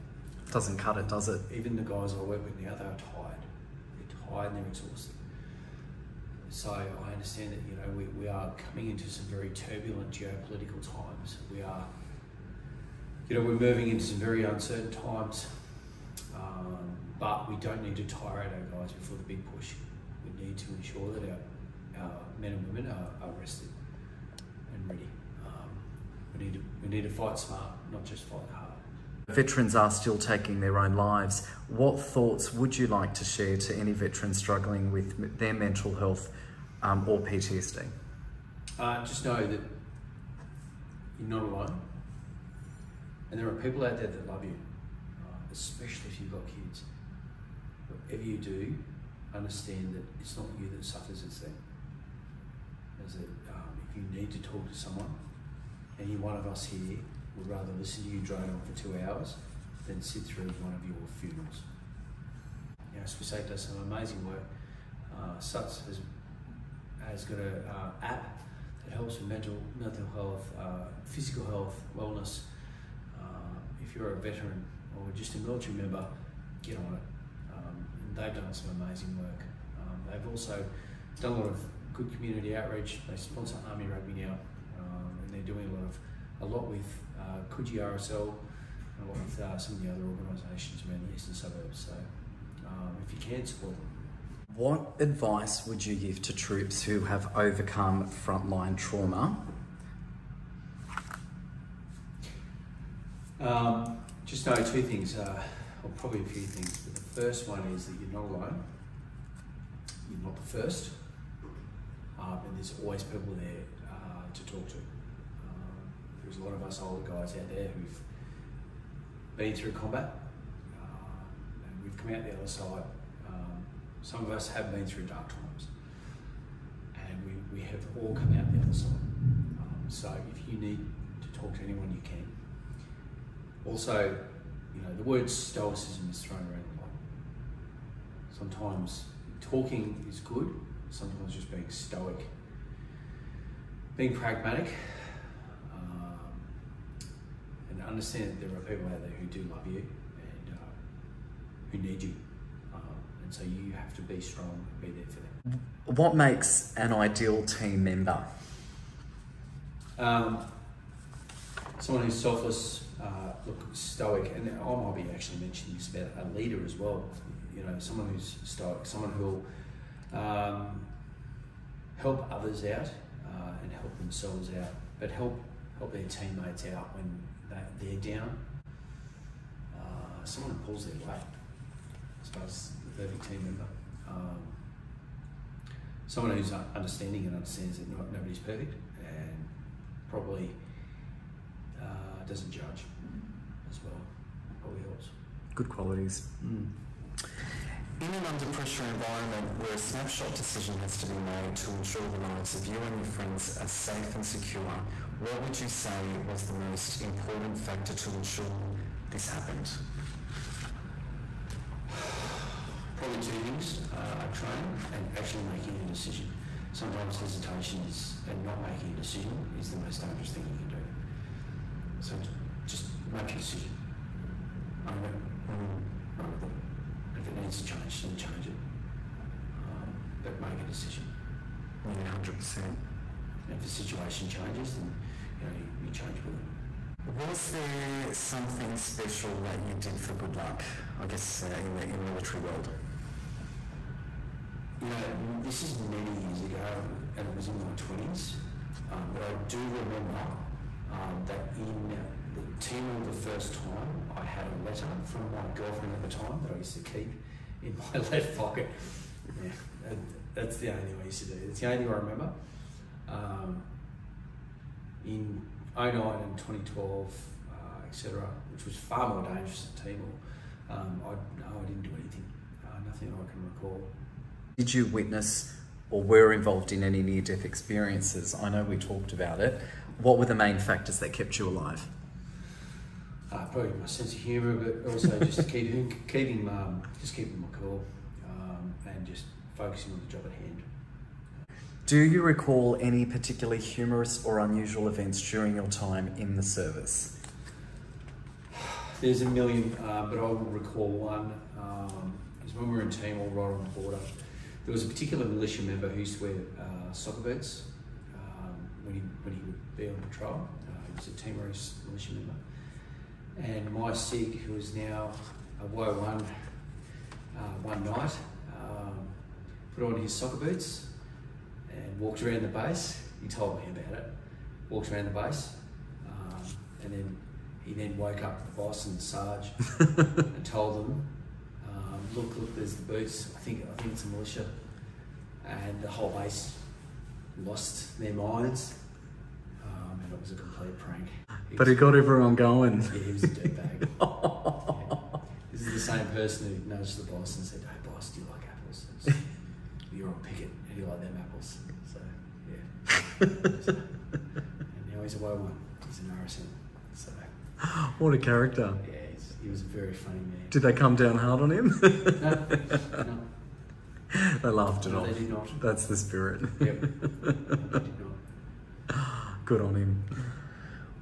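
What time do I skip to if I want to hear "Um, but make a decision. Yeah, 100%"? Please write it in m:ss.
3:49.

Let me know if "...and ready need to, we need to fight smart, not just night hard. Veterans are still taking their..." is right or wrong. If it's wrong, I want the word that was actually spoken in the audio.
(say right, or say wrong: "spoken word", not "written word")
wrong: "fight", not "night".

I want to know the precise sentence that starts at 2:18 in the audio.
Sometimes talking is good, sometimes just being stoic.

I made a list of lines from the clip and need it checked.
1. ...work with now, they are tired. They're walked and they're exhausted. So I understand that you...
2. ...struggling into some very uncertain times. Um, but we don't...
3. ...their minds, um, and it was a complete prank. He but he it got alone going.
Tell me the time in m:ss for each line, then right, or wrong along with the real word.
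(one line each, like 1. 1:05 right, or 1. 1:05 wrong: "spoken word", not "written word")
1. 0:02 wrong: "tired", not "walked"
2. 0:13 wrong: "moving", not "struggling"
3. 5:37 wrong: "everyone", not "alone".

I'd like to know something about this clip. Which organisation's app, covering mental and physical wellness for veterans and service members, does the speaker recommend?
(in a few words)
Swiss8.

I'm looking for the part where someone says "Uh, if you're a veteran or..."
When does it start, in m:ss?
1:13.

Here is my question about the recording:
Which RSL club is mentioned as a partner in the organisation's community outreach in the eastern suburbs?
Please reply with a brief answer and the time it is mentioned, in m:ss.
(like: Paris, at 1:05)
Coogee RSL, at 1:27.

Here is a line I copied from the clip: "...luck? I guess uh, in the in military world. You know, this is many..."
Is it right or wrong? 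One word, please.
right.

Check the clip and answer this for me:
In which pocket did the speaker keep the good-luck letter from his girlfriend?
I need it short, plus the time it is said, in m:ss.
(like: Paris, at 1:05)
Left pocket, at 4:18.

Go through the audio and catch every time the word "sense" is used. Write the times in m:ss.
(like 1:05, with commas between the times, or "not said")
4:43.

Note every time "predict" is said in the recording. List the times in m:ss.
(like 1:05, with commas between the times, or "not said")
not said.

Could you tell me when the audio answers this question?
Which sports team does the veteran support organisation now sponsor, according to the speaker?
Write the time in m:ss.
1:23.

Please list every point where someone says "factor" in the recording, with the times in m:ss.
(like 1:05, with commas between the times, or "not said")
3:27, 4:40.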